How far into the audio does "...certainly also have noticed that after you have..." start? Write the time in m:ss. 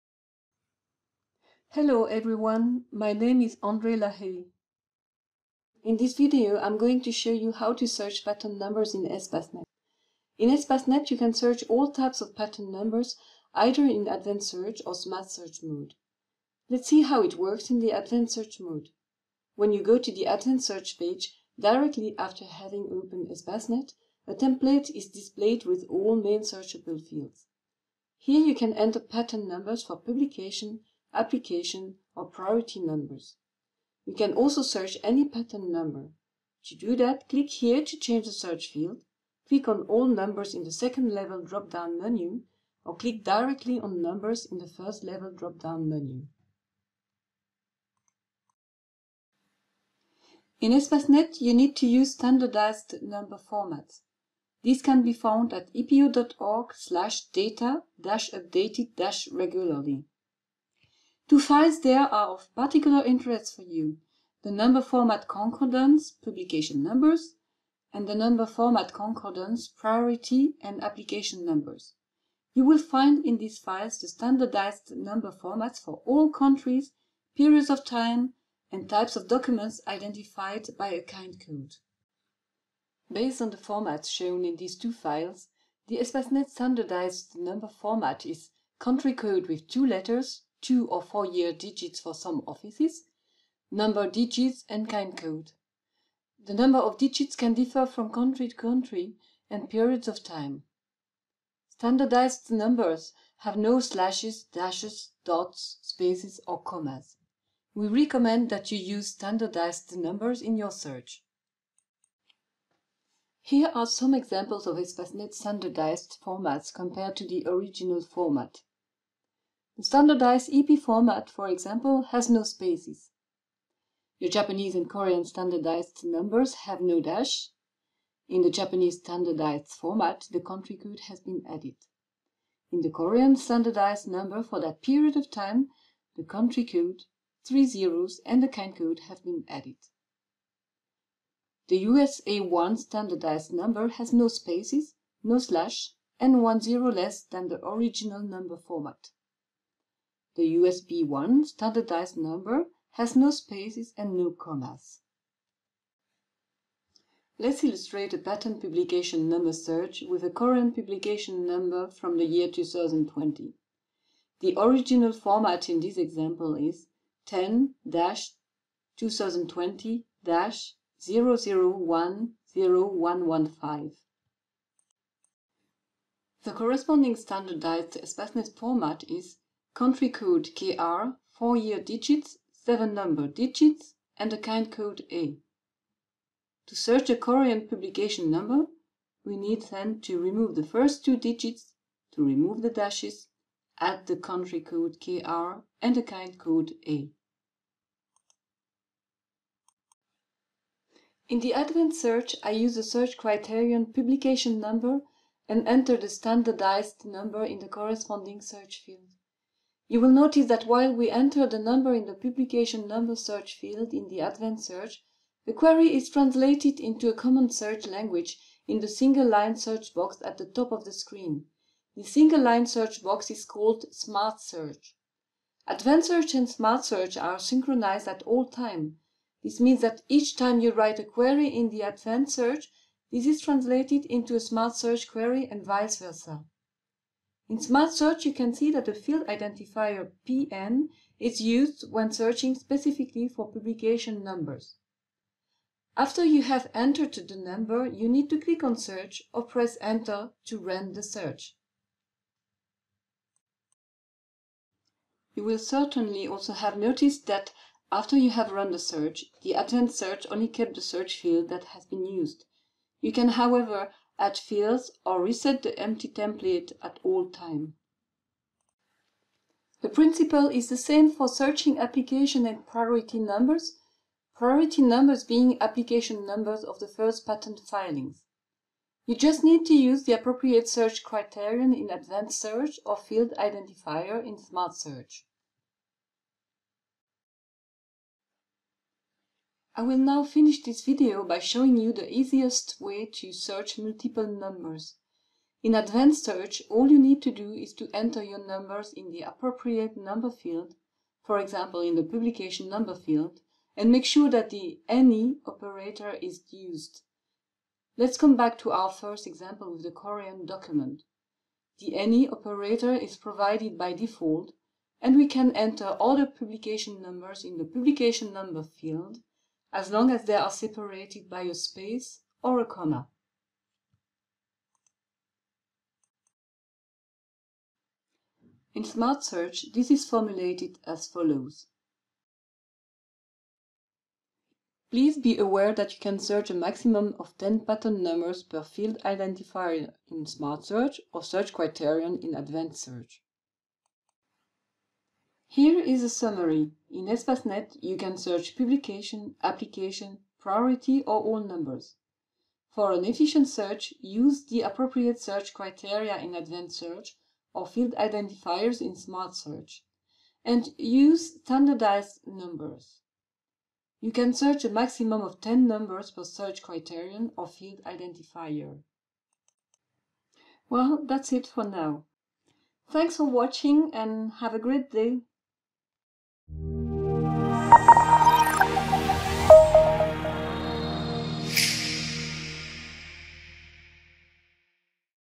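4:15.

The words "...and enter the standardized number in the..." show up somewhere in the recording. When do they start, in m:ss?
3:25.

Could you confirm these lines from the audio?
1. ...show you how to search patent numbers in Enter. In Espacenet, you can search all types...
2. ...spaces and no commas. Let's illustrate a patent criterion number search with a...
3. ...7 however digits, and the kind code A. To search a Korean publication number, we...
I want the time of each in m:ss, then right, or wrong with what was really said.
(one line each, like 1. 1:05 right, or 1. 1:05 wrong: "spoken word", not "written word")
1. 0:07 wrong: "Espacenet", not "Enter"
2. 2:33 wrong: "publication", not "criterion"
3. 3:02 wrong: "number", not "however".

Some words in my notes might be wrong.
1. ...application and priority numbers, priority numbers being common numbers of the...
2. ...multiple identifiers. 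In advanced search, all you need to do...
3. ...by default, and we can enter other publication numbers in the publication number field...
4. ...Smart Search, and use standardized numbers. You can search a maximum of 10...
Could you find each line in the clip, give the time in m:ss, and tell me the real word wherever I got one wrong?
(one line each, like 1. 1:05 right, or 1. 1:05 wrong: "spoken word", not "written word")
1. 4:31 wrong: "application", not "common"
2. 4:53 wrong: "numbers", not "identifiers"
3. 5:13 right
4. 5:58 right.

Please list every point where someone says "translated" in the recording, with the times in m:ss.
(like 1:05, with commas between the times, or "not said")
3:36, 3:53.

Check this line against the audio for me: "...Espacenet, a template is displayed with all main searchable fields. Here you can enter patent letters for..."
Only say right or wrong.
wrong.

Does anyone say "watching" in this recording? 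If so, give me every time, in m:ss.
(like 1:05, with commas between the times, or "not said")
6:13.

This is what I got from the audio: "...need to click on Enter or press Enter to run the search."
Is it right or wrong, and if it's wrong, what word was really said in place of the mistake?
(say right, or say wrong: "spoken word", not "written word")
wrong: "Search", not "Enter".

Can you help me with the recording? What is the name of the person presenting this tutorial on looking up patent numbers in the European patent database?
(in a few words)
André Lahaye.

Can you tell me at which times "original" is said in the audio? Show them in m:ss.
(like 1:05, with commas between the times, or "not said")
1:57, 2:27, 2:44.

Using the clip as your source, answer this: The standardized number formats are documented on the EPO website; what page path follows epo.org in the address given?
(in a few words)
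data-updated-regularly.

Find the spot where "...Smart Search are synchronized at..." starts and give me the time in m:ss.
3:46.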